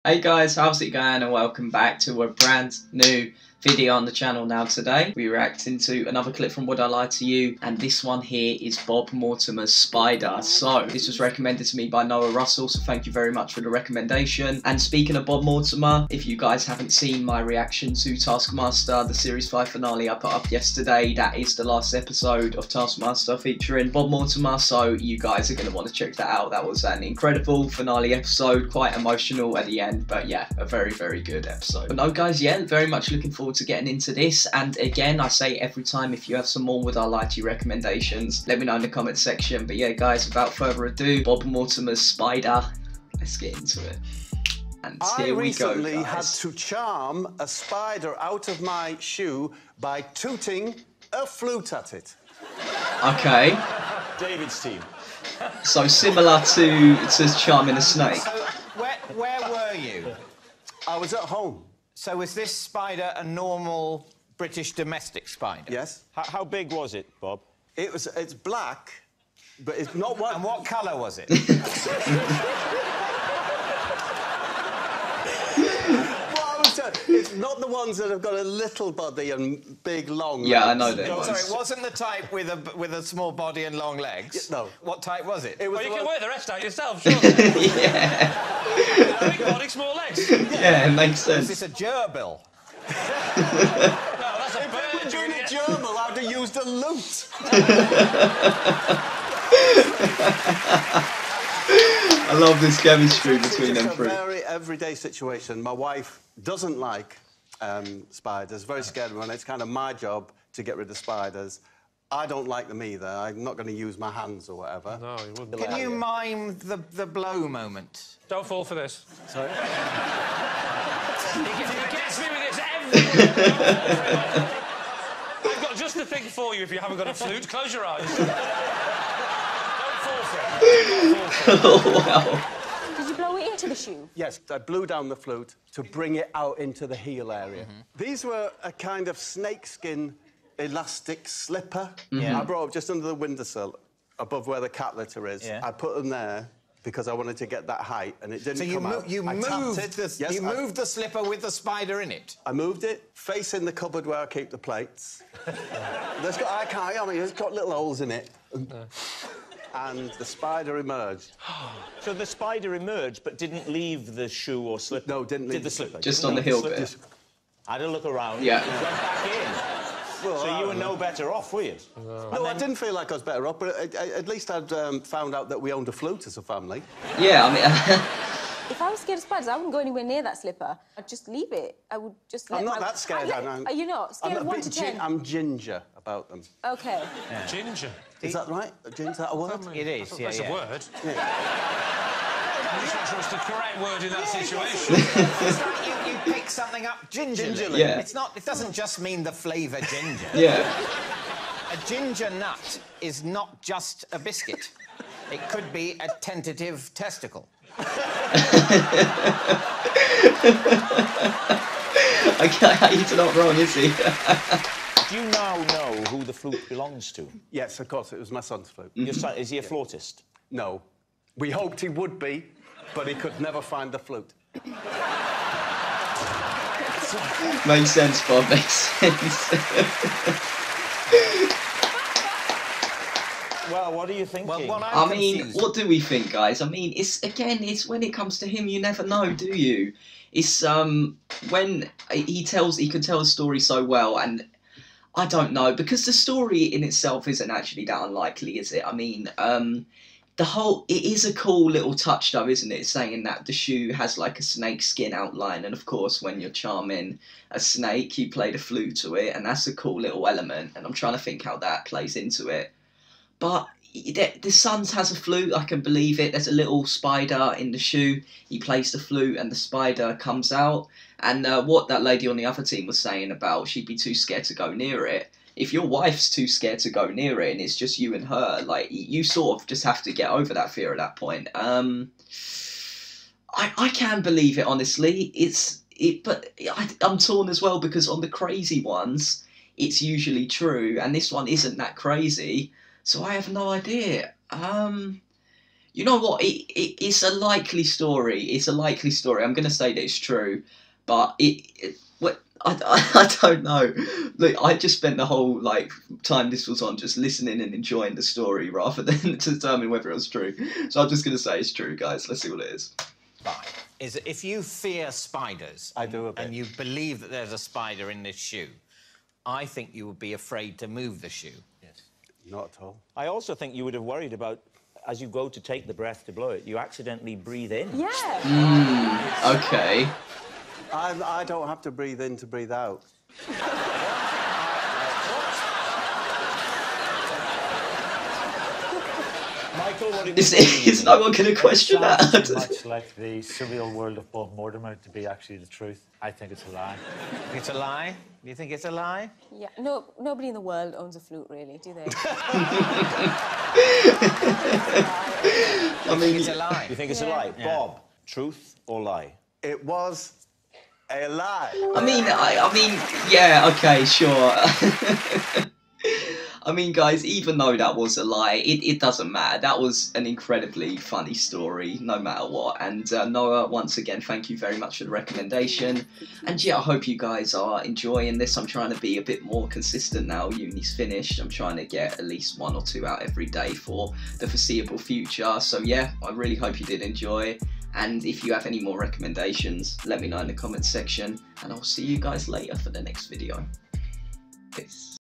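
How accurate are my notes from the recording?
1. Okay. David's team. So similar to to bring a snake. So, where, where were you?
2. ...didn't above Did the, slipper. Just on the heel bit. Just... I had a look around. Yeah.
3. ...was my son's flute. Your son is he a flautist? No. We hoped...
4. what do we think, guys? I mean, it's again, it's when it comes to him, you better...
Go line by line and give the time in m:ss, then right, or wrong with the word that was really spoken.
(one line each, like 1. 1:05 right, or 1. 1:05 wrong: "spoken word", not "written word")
1. 0:53 wrong: "charming", not "bring"
2. 2:45 wrong: "leave", not "above"
3. 3:38 right
4. 3:55 wrong: "never", not "better".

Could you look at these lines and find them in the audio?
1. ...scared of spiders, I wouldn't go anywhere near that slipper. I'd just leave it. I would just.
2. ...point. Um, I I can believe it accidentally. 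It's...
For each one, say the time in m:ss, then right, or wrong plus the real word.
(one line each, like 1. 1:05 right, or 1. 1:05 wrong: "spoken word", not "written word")
1. 2:59 right
2. 4:41 wrong: "honestly", not "accidentally".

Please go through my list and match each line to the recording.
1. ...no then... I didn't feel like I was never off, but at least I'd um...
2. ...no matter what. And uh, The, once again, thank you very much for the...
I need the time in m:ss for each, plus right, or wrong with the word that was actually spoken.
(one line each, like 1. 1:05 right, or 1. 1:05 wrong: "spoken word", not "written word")
1. 2:52 wrong: "better", not "never"
2. 6:11 wrong: "Noah", not "The".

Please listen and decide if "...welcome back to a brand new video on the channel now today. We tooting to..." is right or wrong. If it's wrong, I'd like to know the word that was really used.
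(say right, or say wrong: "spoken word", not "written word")
wrong: "reacting", not "tooting".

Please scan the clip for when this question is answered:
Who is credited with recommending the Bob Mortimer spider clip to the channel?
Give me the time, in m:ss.
0:12.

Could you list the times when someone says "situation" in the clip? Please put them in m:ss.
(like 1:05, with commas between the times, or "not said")
1:44, 3:14.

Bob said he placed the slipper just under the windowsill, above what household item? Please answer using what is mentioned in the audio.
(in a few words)
The cat litter.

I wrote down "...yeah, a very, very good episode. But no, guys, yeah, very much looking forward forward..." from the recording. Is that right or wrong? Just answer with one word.
right.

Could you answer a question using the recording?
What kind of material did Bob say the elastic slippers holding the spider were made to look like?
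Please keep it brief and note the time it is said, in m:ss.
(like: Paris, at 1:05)
Snakeskin, at 2:19.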